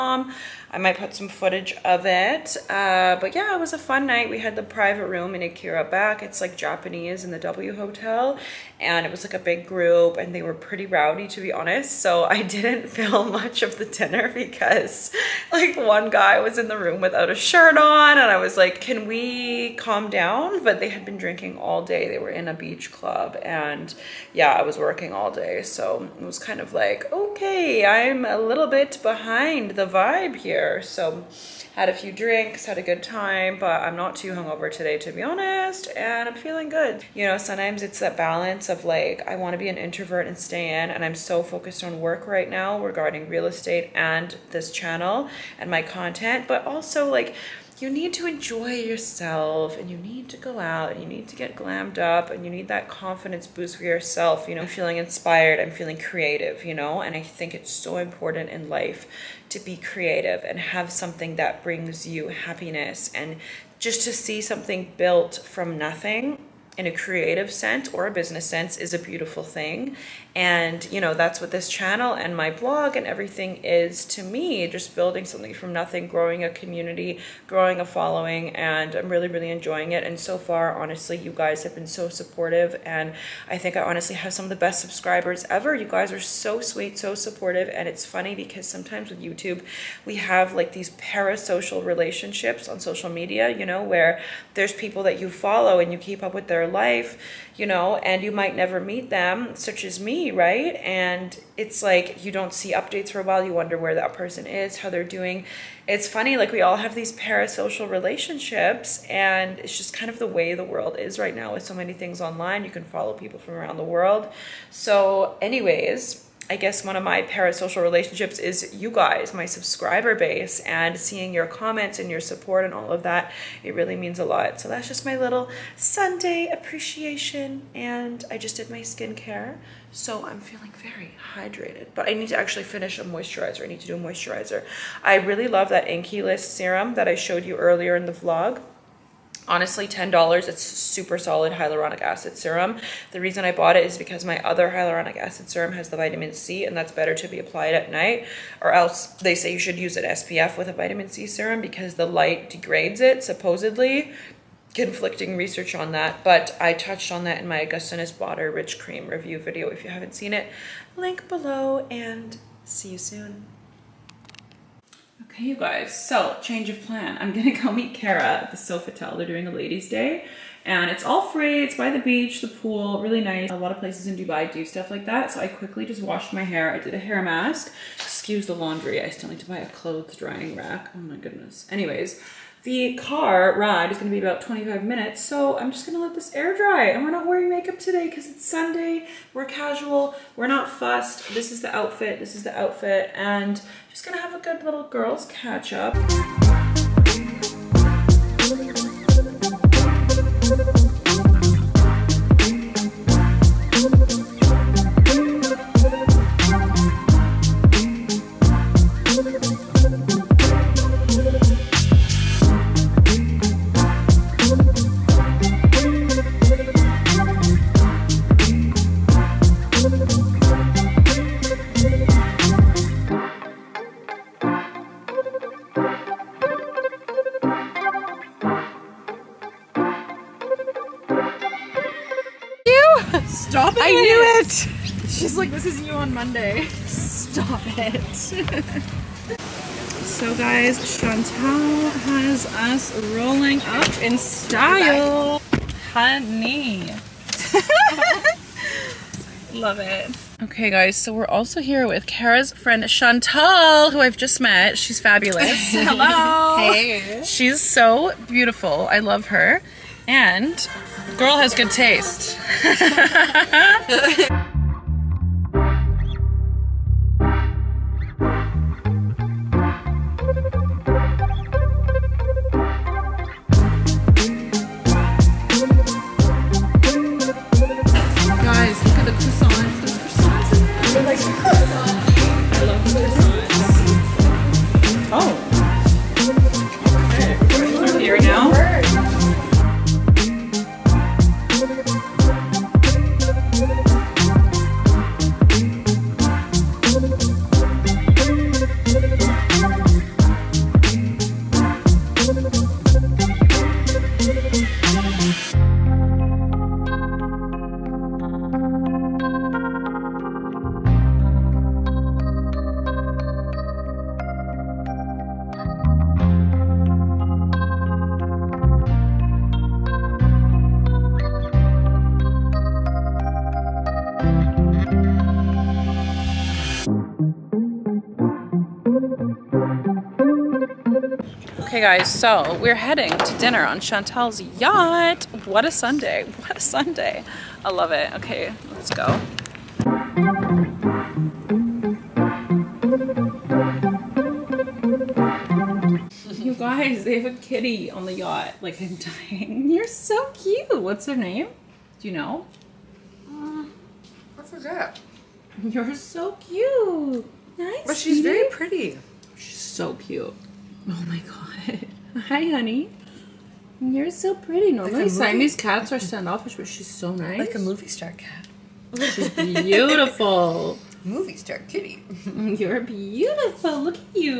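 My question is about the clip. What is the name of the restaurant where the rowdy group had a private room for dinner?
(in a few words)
Akira Back.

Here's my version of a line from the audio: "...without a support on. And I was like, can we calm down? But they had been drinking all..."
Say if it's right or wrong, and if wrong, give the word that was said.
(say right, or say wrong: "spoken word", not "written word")
wrong: "shirt", not "support".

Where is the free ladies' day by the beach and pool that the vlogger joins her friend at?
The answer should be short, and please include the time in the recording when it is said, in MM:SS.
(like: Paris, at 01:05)
Sofitel, at 02:48.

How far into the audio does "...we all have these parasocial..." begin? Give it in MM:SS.
01:46.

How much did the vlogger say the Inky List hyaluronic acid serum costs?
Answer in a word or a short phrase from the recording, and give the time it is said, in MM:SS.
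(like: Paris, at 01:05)
$10, at 02:19.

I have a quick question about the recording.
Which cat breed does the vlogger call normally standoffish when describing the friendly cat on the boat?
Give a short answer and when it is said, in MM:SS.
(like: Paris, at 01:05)
Siamese, at 06:05.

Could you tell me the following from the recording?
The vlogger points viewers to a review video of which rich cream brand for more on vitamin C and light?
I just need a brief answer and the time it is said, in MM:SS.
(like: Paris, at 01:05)
Augustinus Bader, at 02:37.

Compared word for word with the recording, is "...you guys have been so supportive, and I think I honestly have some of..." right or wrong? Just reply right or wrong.
right.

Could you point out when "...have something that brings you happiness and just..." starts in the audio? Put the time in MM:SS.
01:00.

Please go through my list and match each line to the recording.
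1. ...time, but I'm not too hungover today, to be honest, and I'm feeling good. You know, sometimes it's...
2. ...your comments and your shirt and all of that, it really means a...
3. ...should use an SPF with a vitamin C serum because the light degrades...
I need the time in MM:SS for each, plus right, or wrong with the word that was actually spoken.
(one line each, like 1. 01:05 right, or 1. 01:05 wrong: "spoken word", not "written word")
1. 00:33 right
2. 02:01 wrong: "support", not "shirt"
3. 02:29 right.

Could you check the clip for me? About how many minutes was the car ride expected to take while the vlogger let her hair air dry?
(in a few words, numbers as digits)
25 minutes.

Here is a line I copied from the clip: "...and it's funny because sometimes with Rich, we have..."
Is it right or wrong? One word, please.
wrong.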